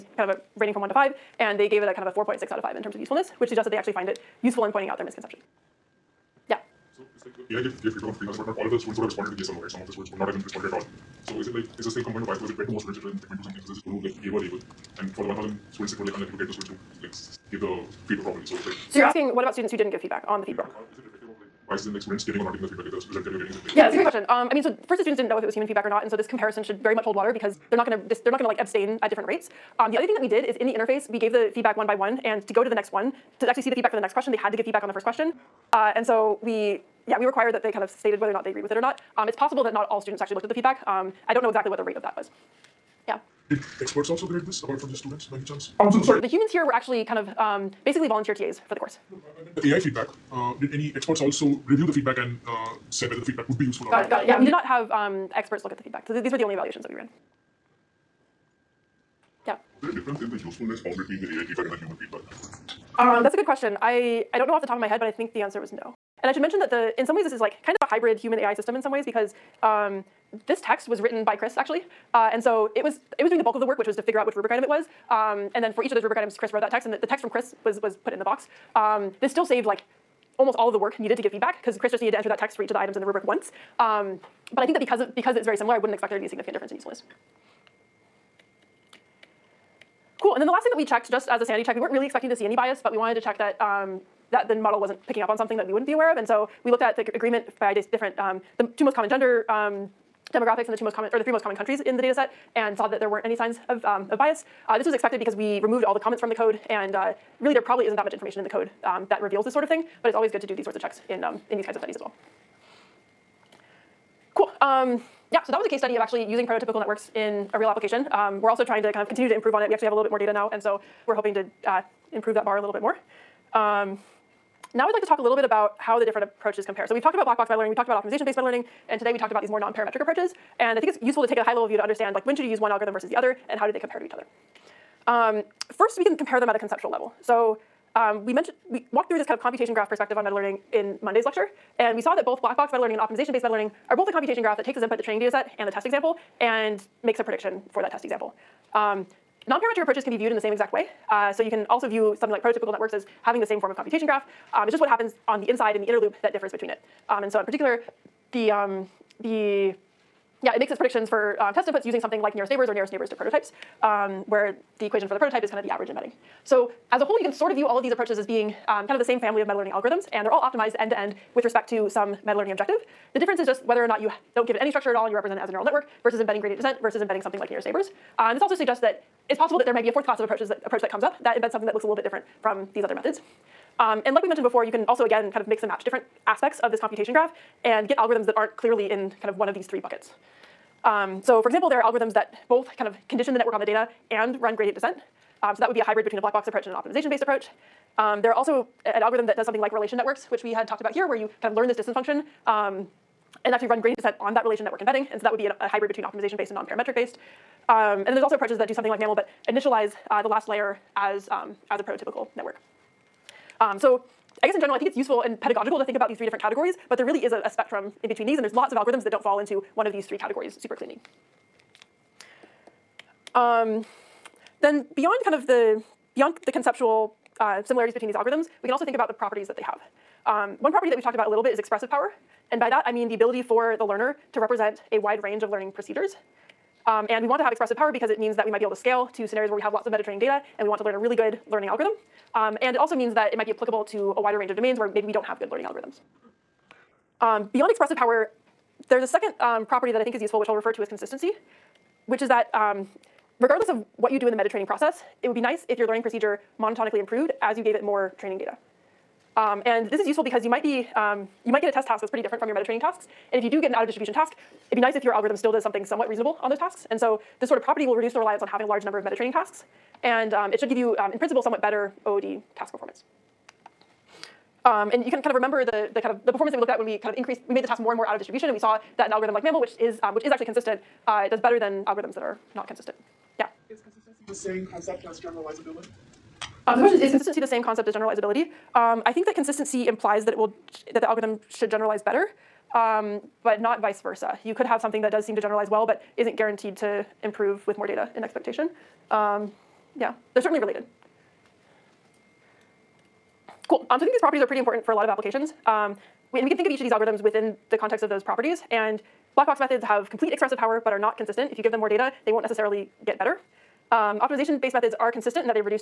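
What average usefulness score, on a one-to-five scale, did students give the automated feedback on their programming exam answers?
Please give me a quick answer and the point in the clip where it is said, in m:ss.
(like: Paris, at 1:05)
4.6, at 0:02.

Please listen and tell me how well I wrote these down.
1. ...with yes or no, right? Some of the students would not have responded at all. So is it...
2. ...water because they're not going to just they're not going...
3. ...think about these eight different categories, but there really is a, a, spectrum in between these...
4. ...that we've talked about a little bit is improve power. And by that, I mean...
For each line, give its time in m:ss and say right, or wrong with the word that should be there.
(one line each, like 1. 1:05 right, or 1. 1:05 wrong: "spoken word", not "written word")
1. 0:09 right
2. 0:27 right
3. 3:35 wrong: "three", not "eight"
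4. 3:50 wrong: "expressive", not "improve".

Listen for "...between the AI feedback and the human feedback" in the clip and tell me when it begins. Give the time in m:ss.
1:00.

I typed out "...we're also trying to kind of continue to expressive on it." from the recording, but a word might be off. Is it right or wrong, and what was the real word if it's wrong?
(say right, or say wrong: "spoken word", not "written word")
wrong: "improve", not "expressive".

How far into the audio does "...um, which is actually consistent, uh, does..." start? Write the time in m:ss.
4:40.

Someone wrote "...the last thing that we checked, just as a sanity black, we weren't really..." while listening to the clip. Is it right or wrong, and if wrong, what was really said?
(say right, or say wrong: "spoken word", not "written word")
wrong: "check", not "black".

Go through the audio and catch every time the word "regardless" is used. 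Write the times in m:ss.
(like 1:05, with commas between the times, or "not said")
4:13.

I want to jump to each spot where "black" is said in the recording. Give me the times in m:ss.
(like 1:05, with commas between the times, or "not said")
2:07, 2:22, 3:16, 5:09.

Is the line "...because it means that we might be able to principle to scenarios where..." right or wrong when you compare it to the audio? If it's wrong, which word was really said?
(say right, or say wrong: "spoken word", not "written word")
wrong: "scale", not "principle".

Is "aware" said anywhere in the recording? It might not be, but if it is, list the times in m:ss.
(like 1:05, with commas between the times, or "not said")
1:35.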